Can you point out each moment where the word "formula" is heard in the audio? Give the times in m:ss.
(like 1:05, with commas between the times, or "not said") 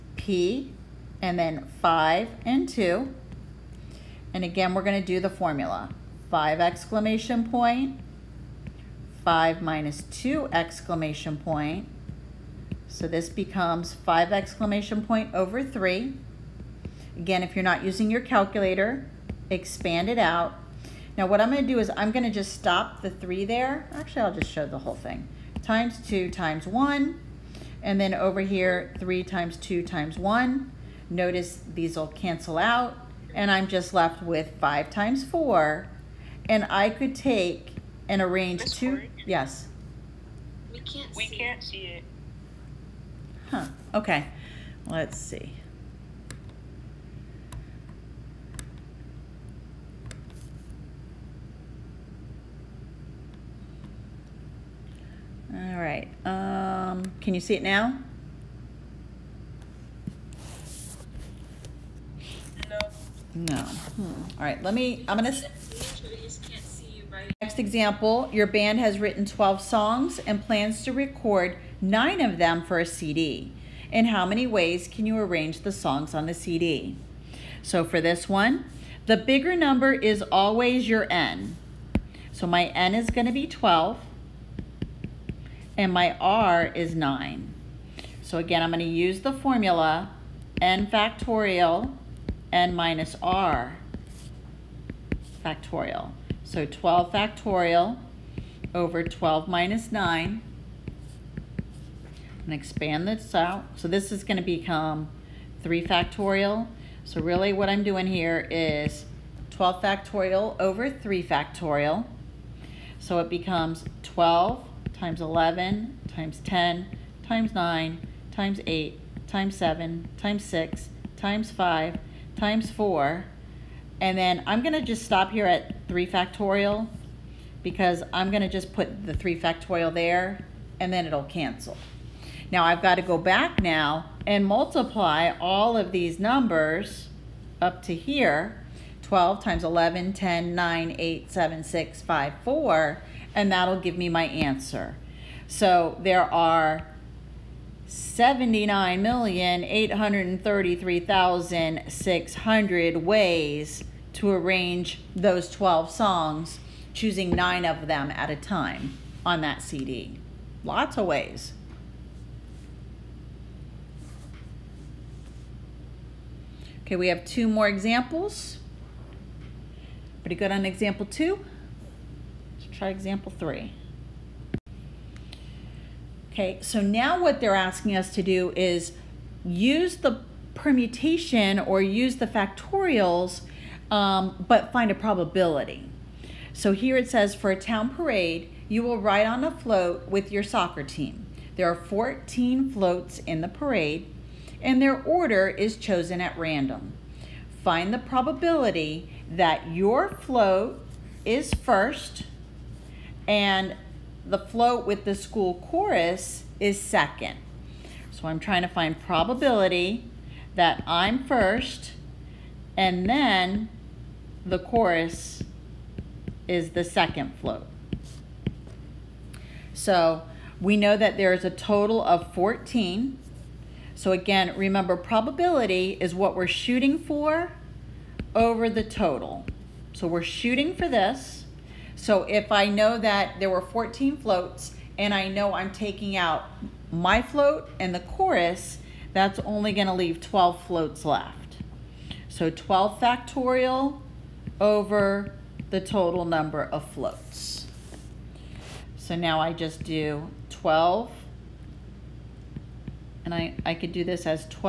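0:05, 1:29.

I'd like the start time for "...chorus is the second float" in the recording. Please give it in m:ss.
3:34.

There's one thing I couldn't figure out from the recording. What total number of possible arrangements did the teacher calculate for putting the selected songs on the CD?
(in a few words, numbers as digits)
79,833,600.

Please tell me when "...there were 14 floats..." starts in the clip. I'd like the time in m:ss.
3:53.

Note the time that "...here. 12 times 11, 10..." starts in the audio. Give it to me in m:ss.
2:17.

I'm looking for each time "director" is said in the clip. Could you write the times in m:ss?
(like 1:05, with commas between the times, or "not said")
not said.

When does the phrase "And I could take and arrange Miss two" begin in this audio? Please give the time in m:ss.
0:36.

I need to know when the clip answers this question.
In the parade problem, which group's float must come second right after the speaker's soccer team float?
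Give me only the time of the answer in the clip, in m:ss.
3:25.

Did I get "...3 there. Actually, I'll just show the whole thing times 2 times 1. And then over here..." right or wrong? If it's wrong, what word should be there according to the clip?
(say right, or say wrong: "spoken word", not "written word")
right.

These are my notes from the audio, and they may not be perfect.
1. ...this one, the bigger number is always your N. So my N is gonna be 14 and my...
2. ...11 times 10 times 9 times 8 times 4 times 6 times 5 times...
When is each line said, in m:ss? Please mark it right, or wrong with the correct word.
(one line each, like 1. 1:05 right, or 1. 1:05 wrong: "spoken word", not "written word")
1. 1:18 wrong: "12", not "14"
2. 1:55 wrong: "7", not "4".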